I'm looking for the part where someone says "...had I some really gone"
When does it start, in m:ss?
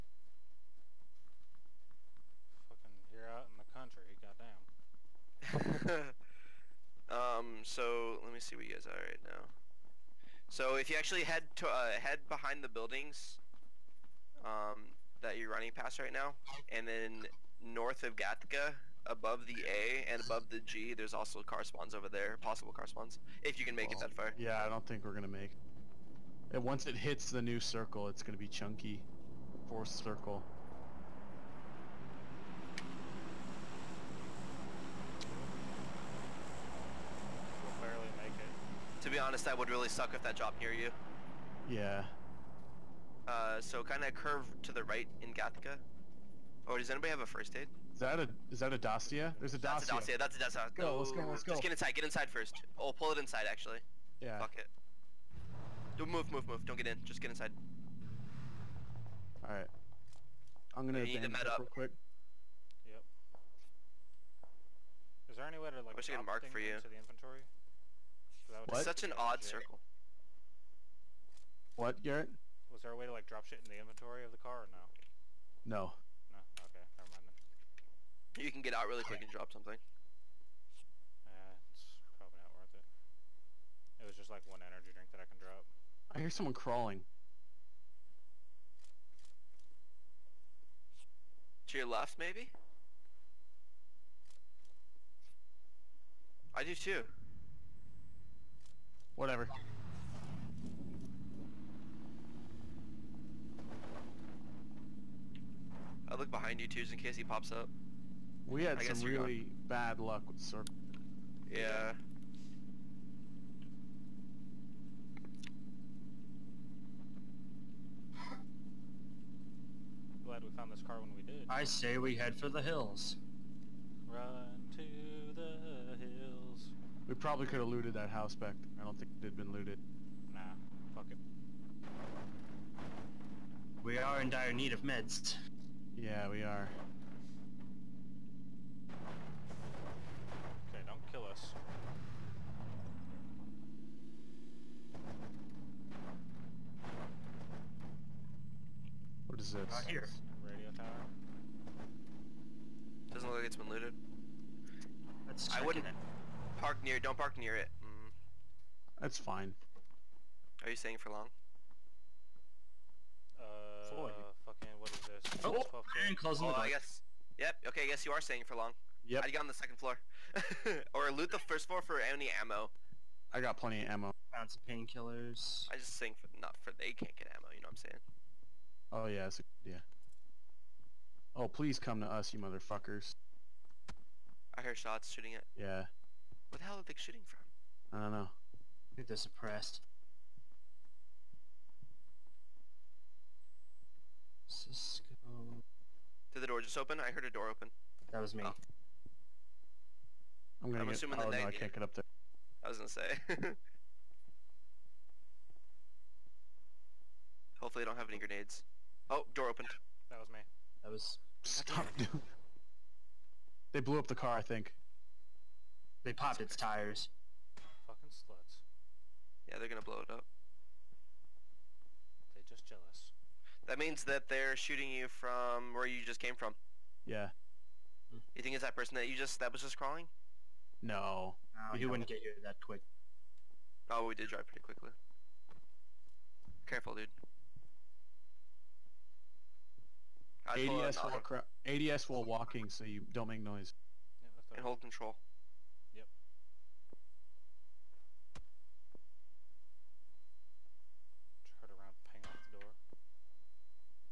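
1:48.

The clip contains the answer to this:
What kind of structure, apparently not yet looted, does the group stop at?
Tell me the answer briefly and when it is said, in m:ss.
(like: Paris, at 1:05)
Radio tower, at 2:30.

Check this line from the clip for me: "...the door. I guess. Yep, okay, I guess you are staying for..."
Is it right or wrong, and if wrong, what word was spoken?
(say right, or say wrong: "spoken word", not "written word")
right.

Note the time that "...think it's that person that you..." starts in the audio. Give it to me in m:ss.
3:48.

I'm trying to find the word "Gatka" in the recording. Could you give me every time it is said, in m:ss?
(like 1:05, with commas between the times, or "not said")
0:18, 0:45.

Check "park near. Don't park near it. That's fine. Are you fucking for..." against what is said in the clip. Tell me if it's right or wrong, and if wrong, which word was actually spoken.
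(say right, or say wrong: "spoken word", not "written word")
wrong: "staying", not "fucking".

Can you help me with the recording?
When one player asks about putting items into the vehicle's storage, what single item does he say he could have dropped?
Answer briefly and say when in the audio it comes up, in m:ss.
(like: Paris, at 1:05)
energy drink, at 1:24.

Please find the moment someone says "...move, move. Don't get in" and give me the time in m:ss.
0:56.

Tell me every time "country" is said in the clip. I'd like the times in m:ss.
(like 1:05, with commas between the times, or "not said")
0:05.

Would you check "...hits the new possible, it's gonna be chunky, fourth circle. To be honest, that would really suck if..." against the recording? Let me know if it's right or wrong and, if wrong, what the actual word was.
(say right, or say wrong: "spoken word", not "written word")
wrong: "circle", not "possible".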